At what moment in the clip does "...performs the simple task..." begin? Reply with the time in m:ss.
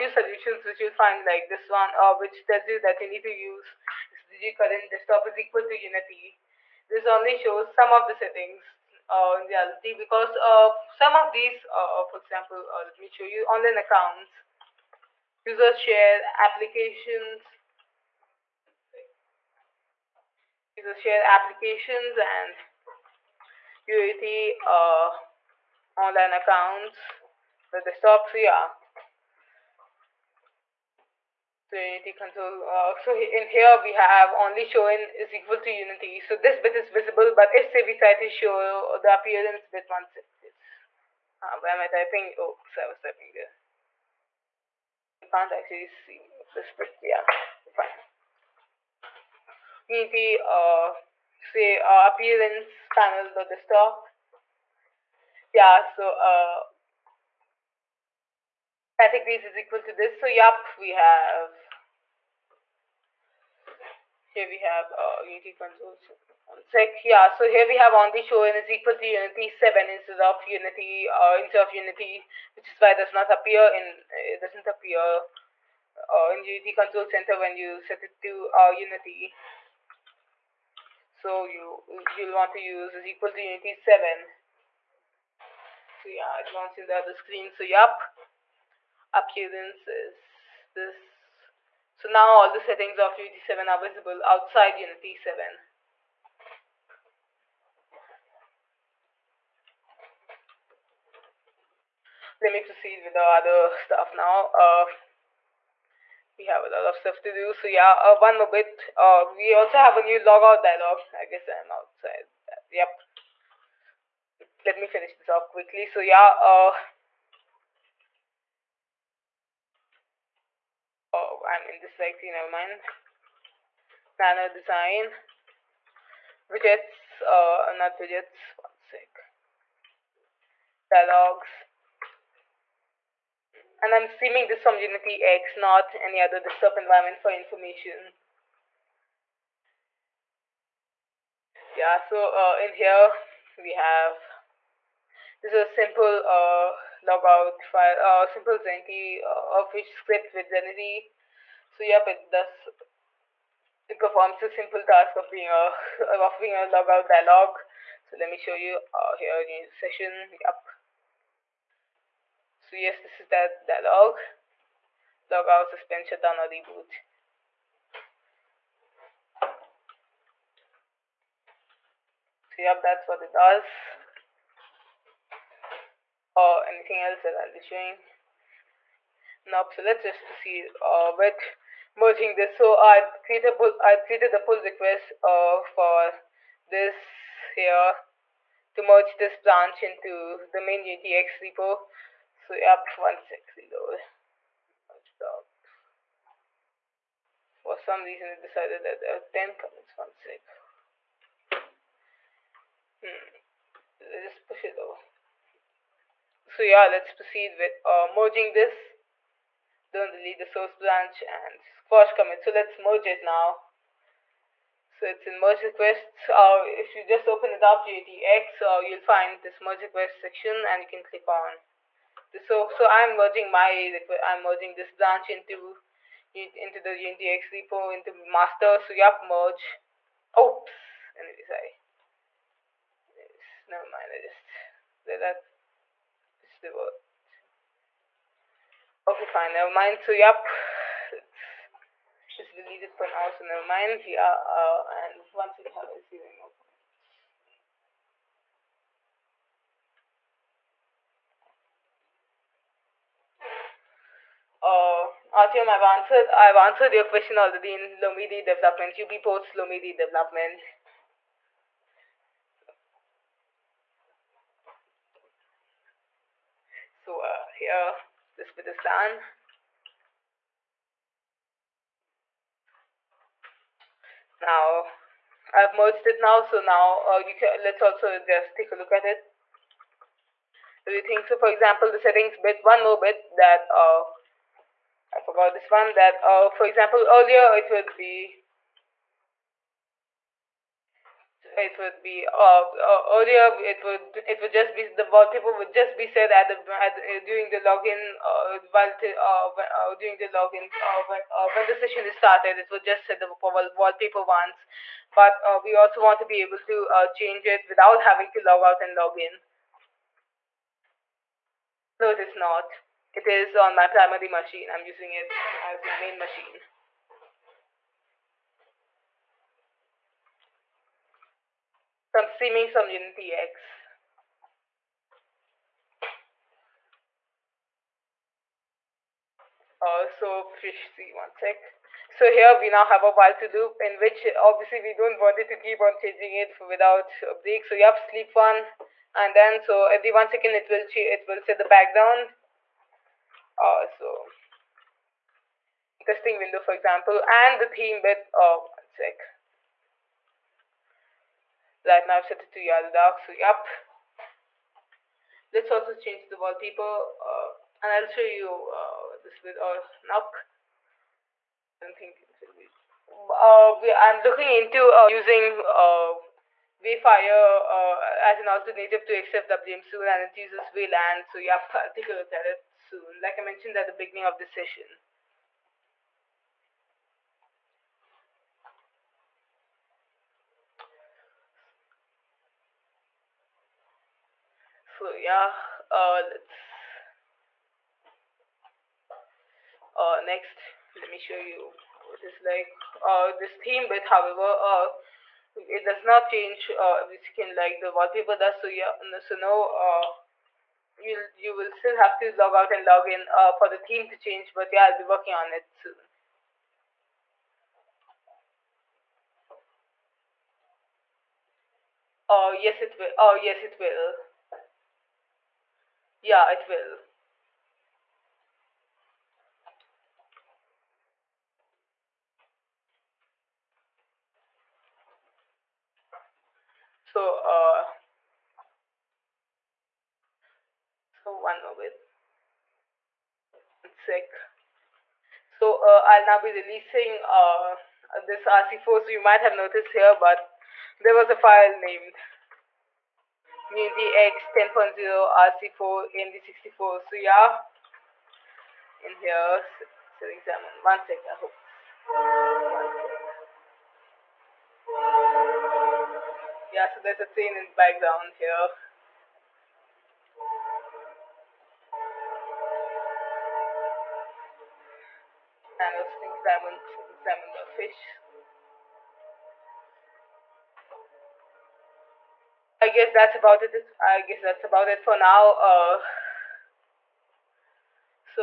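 2:33.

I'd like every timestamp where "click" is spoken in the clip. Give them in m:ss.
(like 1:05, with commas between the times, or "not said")
3:41.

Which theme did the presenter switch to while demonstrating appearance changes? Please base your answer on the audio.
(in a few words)
Yaru Dark.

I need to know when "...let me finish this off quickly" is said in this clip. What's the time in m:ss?
1:54.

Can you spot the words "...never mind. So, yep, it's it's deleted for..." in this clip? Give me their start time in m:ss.
3:59.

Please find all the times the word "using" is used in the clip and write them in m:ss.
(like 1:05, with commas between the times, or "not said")
5:14, 6:05.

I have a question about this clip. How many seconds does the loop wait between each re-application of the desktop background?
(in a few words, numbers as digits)
1.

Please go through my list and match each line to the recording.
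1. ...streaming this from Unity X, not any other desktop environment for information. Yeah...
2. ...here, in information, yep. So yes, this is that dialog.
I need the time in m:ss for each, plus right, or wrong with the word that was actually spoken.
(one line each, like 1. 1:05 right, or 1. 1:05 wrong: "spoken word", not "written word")
1. 2:14 right
2. 2:39 wrong: "session", not "information".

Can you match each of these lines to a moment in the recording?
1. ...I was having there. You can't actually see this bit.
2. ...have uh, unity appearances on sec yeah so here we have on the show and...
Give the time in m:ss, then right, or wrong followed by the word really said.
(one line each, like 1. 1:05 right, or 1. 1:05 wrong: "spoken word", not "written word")
1. 0:42 wrong: "typing", not "having"
2. 1:04 wrong: "consoles", not "appearances".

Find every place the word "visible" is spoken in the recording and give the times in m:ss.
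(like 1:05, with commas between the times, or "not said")
0:36, 1:33.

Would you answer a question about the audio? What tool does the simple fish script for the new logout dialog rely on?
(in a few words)
Zenity.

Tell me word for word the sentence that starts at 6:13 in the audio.
Like I mentioned at the beginning of the session.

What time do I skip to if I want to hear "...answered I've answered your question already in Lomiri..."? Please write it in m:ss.
4:15.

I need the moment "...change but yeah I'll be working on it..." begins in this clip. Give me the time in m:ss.
6:44.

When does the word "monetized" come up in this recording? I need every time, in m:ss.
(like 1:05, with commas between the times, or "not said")
not said.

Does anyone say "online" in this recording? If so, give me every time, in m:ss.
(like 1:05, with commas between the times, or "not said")
0:13, 0:25.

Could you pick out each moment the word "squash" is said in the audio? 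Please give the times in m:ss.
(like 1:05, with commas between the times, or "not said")
3:31.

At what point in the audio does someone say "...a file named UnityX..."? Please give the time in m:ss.
7:21.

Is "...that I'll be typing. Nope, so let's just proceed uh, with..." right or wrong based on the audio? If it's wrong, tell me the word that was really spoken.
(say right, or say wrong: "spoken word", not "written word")
wrong: "showing", not "typing".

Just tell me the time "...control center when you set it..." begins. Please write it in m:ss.
1:16.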